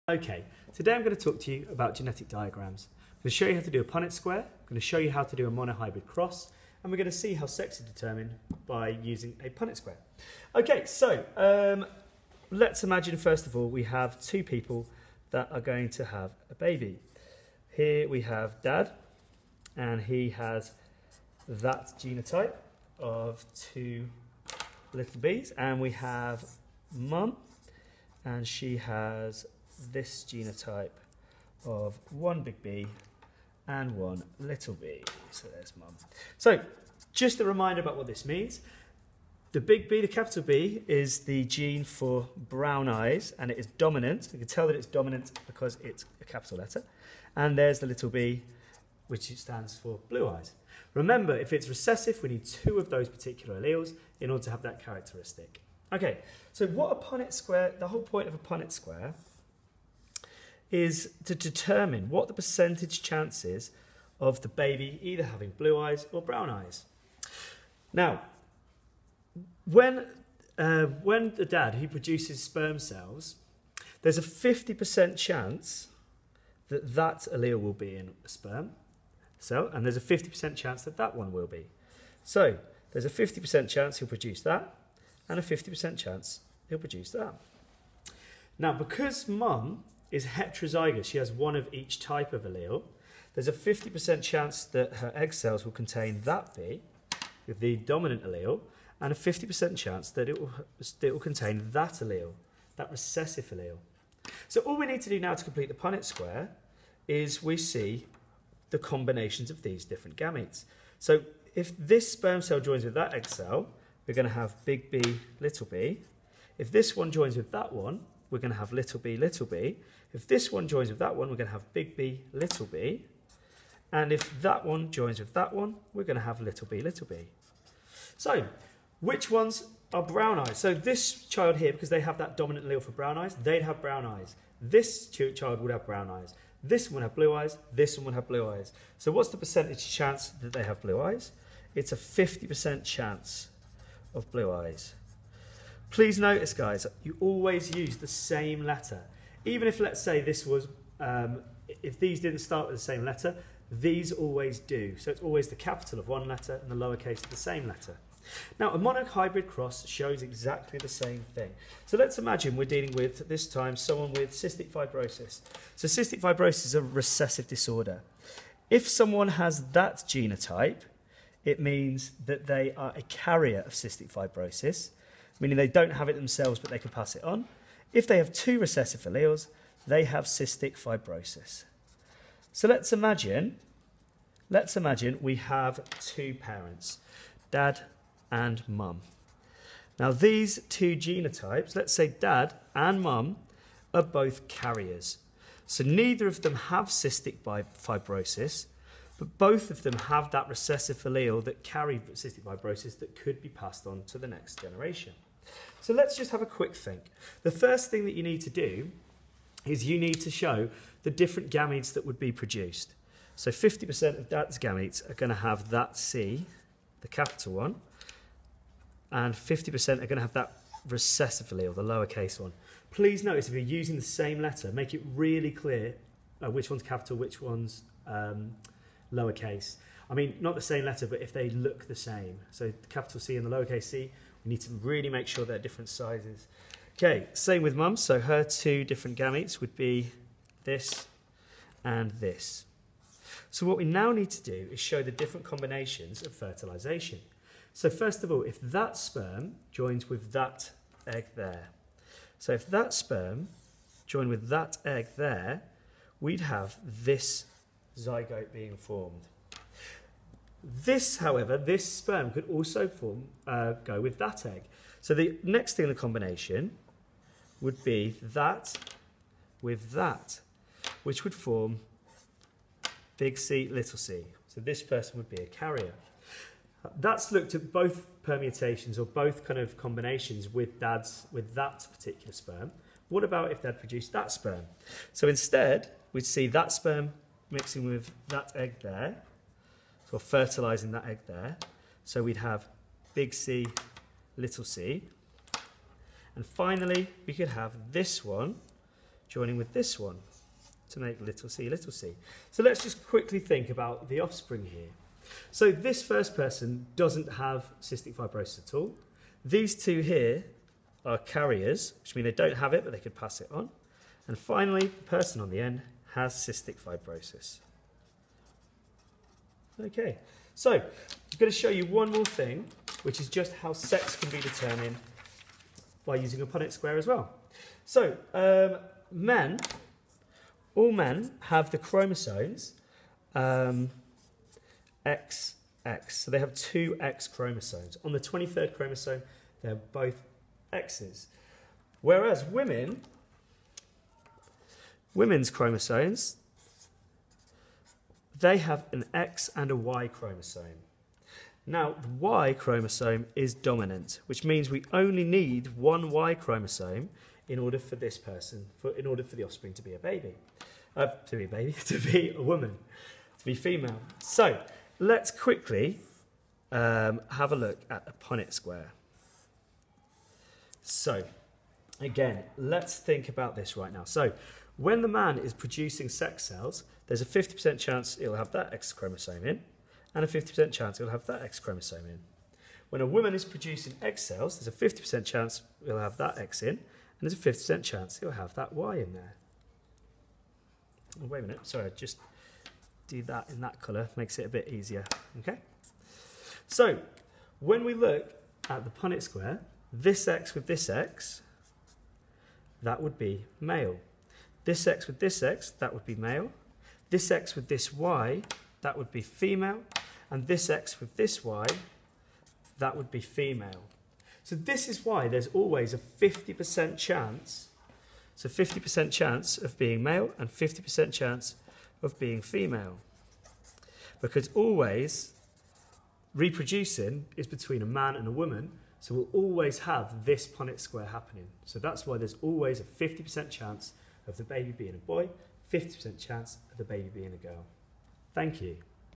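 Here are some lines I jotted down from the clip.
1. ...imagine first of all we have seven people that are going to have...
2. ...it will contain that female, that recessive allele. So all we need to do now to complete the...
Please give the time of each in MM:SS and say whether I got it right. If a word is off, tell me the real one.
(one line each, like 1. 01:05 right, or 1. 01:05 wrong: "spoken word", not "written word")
1. 00:12 wrong: "two", not "seven"
2. 01:41 wrong: "allele", not "female".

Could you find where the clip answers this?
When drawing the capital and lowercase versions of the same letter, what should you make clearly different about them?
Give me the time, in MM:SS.
03:55.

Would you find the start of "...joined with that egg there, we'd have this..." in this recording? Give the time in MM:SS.
04:14.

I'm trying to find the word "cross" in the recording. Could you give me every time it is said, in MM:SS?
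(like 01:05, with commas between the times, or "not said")
00:06, 02:39.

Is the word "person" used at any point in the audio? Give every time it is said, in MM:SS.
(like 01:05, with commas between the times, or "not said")
04:34, 05:06, 05:15, 05:58.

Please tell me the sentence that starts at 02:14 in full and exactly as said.
This child would have brown eyes.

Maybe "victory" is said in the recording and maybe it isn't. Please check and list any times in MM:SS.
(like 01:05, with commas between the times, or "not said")
not said.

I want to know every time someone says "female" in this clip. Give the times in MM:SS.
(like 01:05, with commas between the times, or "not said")
06:03, 06:49, 06:53, 07:02.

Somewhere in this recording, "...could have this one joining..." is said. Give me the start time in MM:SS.
04:57.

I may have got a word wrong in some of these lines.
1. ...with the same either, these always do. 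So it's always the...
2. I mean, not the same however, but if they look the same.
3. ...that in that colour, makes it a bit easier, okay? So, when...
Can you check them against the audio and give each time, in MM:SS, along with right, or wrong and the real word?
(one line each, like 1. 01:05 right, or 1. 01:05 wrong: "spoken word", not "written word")
1. 02:32 wrong: "letter", not "either"
2. 03:50 wrong: "letter", not "however"
3. 06:33 right.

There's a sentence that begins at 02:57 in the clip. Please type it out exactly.
If they have two recessive alleles, they have cystic fibrosis.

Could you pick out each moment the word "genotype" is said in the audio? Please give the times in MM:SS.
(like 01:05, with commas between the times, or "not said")
00:21, 00:30, 02:49, 03:10.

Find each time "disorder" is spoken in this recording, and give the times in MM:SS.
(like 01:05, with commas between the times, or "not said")
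02:47.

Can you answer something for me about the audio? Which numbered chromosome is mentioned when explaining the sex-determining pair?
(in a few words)
23rd.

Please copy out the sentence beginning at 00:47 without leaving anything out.
And there's the little b, which stands for blue eyes.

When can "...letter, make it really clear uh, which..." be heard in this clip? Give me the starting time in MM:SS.
03:44.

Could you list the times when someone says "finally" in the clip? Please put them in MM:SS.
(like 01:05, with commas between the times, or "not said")
04:56, 05:14.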